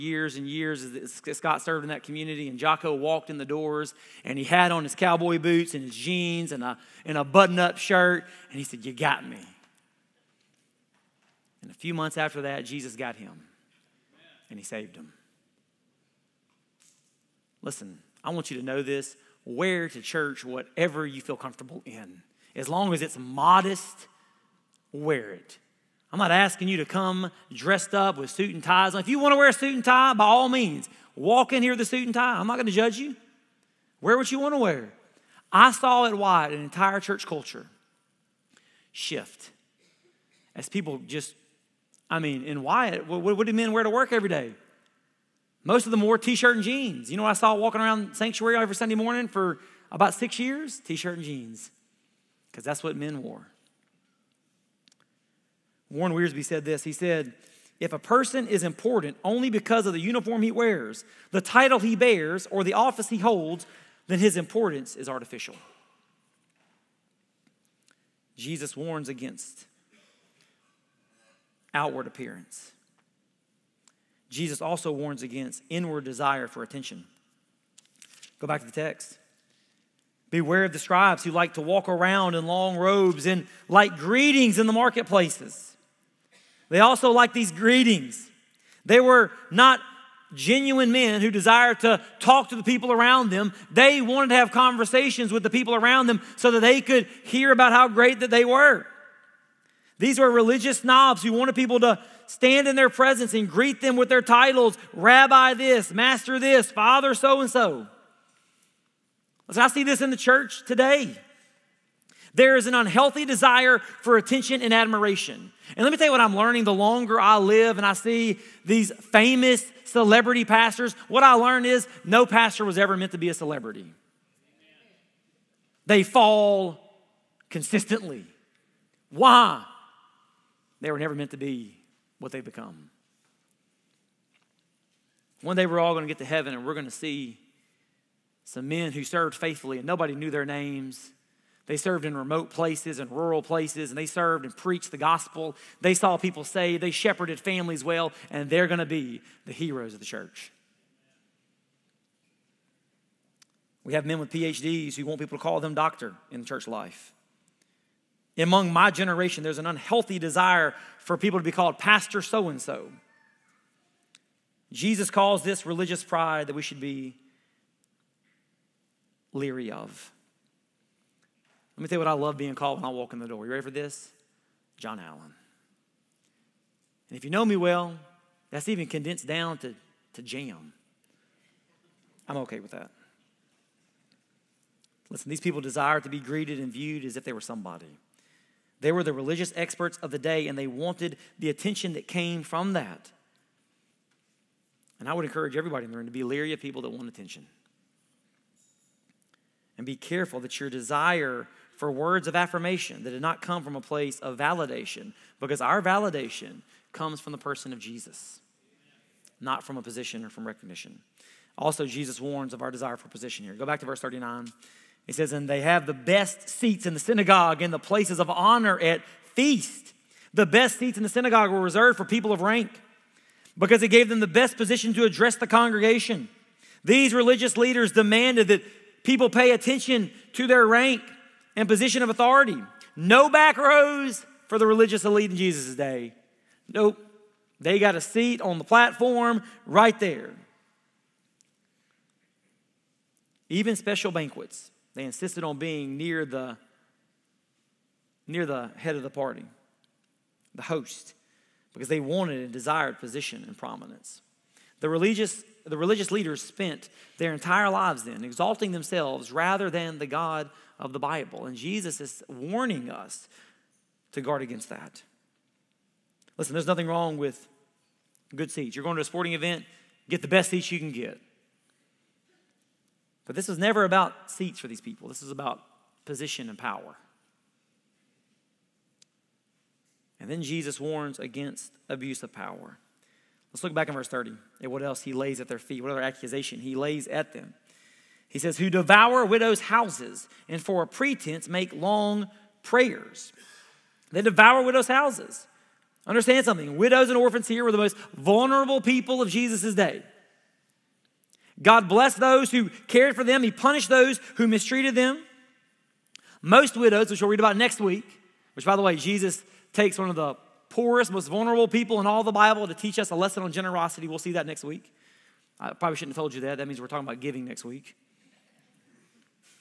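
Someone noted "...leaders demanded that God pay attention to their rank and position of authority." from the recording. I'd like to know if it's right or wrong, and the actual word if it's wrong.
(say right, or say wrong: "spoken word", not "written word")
wrong: "People", not "God".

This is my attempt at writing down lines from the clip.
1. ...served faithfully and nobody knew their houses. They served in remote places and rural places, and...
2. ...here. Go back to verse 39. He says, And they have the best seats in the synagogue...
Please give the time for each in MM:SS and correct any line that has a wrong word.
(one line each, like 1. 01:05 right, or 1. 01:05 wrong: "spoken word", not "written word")
1. 02:19 wrong: "names", not "houses"
2. 03:33 right.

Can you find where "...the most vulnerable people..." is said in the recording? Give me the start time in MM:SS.
04:57.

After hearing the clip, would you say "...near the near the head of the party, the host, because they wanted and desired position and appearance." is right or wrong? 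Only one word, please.
wrong.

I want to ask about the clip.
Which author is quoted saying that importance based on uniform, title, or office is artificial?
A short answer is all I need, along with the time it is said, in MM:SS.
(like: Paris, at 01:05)
Warren Wiersbe, at 00:55.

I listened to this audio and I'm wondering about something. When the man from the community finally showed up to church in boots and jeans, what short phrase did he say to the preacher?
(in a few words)
You got me.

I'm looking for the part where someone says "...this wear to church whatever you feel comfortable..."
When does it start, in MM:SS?
00:18.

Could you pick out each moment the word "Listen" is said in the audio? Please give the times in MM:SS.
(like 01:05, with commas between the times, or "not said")
00:17, 03:05, 04:26.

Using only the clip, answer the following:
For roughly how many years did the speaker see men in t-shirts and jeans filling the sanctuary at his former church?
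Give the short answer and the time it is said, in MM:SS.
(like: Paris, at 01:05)
6, at 00:50.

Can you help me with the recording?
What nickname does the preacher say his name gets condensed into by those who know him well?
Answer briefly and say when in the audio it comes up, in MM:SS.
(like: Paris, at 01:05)
Jam, at 03:00.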